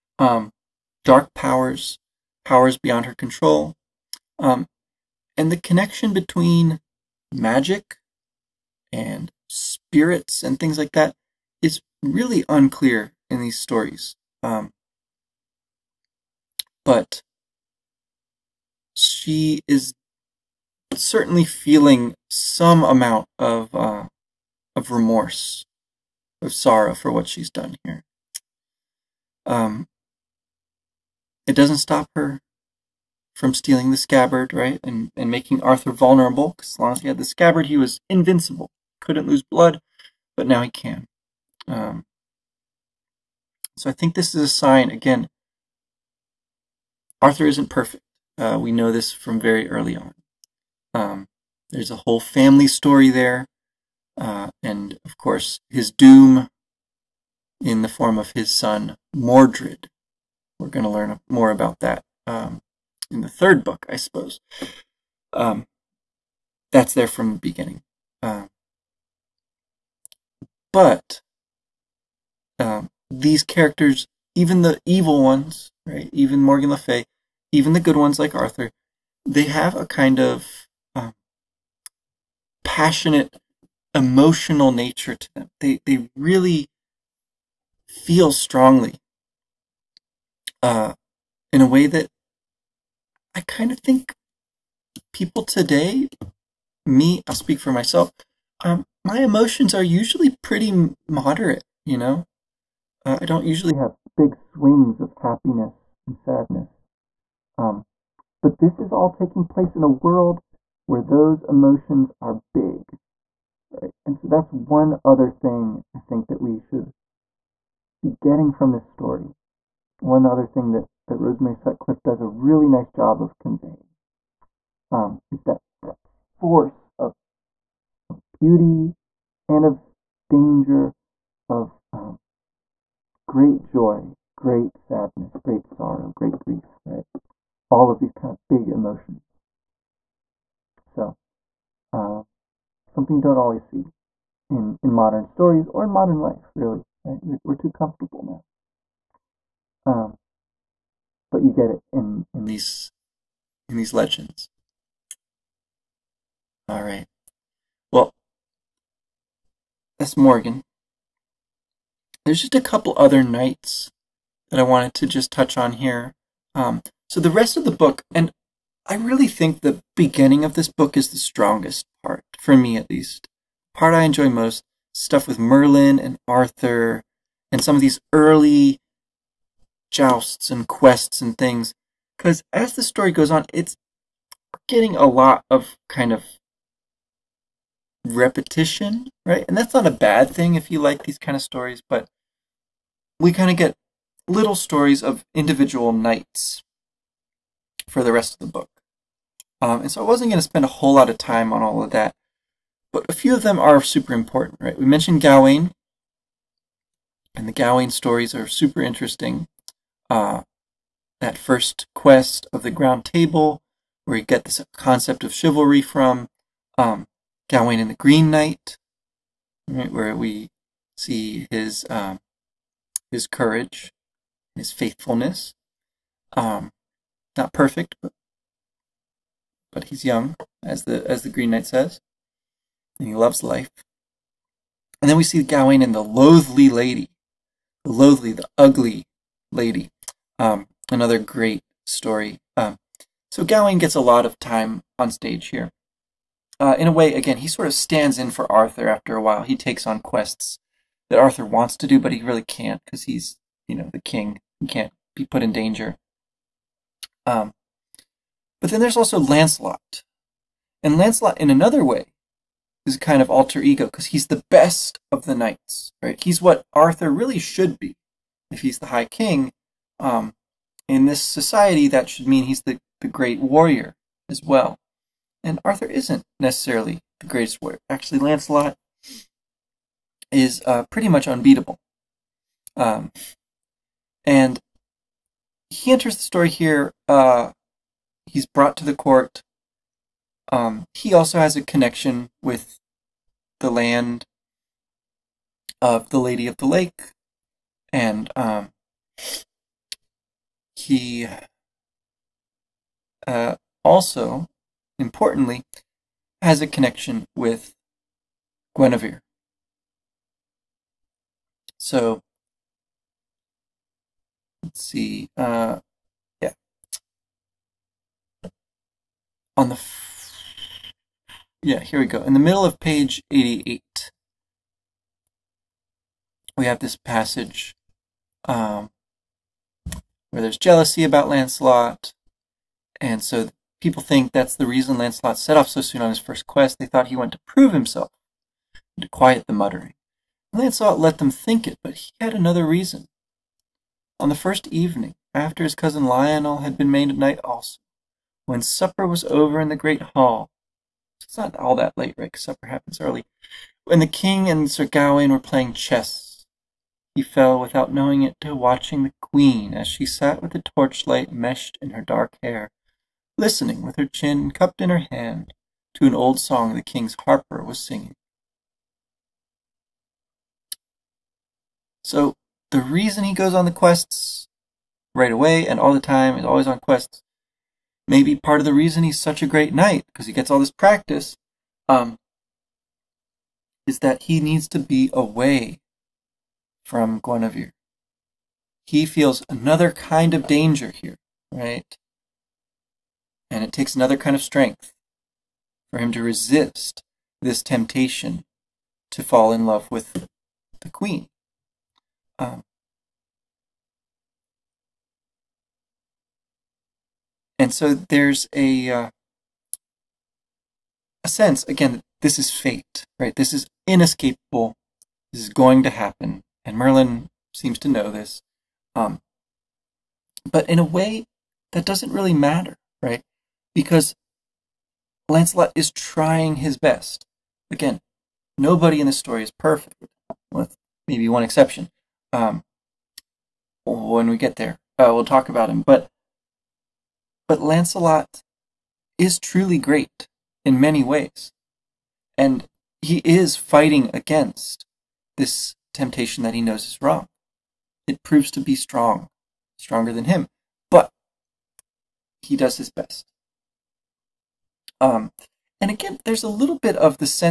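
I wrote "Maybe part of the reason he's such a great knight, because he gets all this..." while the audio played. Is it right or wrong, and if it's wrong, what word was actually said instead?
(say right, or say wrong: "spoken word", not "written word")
right.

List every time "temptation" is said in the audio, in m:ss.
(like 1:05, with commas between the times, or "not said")
6:37, 7:25.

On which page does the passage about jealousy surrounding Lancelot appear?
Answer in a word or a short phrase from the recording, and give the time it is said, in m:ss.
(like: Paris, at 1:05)
88, at 5:22.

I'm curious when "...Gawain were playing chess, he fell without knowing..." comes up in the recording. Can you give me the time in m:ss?
5:54.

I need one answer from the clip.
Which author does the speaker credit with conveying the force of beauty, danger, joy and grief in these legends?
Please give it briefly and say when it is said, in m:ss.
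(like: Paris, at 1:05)
Rosemary Sutcliff, at 2:01.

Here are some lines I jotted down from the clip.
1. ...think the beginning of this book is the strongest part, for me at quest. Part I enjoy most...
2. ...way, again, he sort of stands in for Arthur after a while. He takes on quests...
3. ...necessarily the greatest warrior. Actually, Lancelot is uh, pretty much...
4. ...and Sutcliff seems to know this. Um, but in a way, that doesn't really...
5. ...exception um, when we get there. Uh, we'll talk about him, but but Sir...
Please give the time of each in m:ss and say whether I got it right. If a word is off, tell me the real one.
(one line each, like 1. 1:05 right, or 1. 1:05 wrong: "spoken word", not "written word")
1. 2:49 wrong: "least", not "quest"
2. 4:06 right
3. 4:36 right
4. 6:56 wrong: "Merlin", not "Sutcliff"
5. 7:11 wrong: "Lancelot", not "Sir".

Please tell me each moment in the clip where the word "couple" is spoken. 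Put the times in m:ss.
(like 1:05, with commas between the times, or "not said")
2:42.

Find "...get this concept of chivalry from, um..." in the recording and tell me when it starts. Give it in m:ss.
3:34.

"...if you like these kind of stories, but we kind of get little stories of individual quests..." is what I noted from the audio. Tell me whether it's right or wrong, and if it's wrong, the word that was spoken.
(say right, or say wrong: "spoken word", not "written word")
wrong: "knights", not "quests".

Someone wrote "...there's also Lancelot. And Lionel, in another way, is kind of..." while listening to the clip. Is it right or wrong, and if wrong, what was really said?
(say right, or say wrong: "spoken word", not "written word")
wrong: "Lancelot", not "Lionel".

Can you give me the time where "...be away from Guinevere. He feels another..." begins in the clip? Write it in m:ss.
6:24.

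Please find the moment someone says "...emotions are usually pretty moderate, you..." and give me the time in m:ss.
1:39.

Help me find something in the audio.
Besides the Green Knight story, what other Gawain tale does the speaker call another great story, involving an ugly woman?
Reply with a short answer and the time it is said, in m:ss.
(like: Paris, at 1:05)
The loathly lady, at 3:55.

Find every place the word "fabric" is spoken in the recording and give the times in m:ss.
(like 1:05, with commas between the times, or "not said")
not said.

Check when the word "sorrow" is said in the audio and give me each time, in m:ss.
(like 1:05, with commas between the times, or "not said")
0:26, 2:15.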